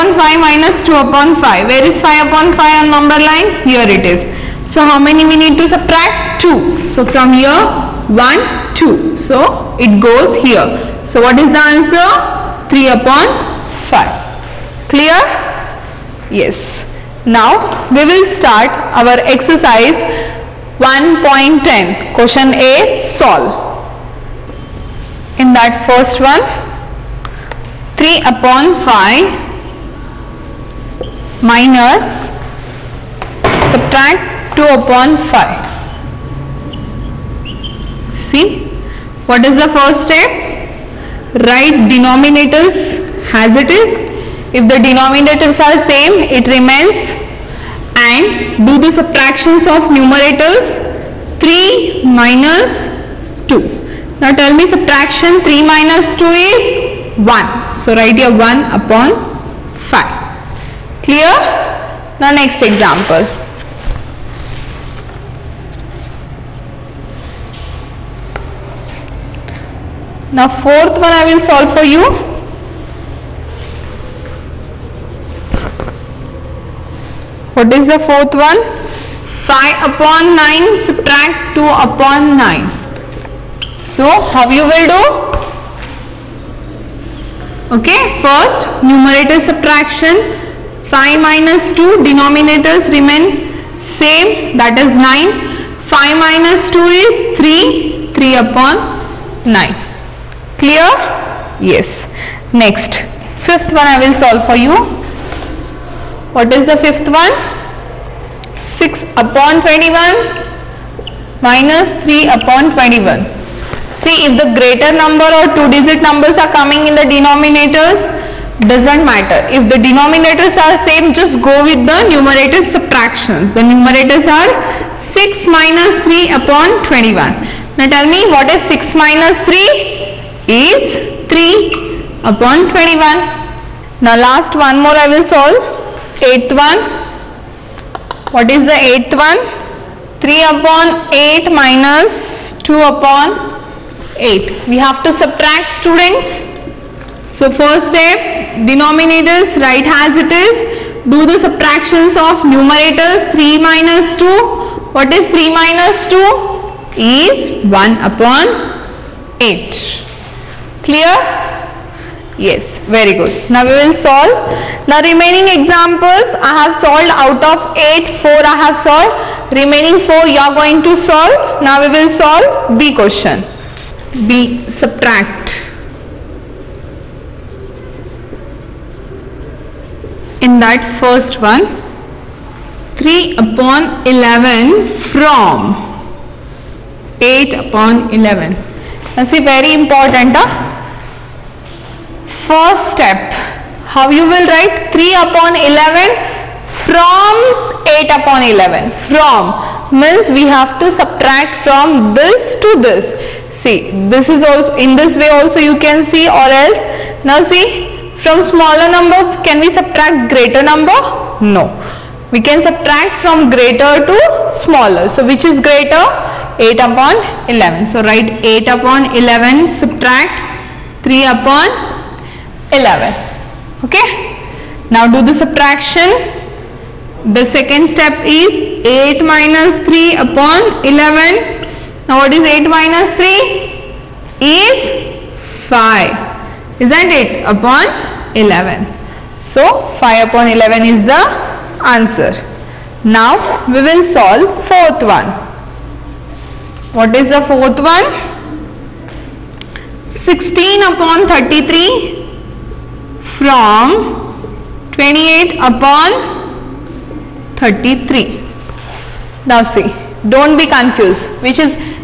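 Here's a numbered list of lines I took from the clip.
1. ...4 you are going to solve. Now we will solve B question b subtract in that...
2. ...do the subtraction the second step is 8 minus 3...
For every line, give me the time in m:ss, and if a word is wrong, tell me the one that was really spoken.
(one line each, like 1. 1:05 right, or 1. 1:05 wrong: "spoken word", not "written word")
1. 2:50 right
2. 3:45 right.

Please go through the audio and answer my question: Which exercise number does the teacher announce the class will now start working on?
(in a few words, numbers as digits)
1.10.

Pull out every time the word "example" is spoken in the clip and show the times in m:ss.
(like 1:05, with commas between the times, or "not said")
1:02, 2:45.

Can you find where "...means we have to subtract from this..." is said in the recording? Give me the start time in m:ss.
3:19.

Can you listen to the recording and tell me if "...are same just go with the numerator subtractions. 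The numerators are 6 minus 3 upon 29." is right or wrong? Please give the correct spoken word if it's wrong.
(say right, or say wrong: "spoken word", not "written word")
wrong: "21", not "29".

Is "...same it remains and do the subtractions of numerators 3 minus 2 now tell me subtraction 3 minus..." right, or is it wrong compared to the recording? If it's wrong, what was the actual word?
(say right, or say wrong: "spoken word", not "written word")
right.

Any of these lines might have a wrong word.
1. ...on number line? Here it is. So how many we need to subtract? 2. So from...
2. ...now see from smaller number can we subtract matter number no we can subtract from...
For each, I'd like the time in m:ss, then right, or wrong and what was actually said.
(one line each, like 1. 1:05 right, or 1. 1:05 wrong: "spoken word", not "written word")
1. 0:02 right
2. 3:27 wrong: "greater", not "matter".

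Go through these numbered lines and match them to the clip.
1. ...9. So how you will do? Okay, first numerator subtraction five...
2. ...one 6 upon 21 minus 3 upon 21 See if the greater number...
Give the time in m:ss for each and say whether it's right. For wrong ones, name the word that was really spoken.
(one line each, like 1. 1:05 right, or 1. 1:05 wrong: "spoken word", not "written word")
1. 1:22 right
2. 1:47 right.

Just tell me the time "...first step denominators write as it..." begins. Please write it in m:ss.
2:27.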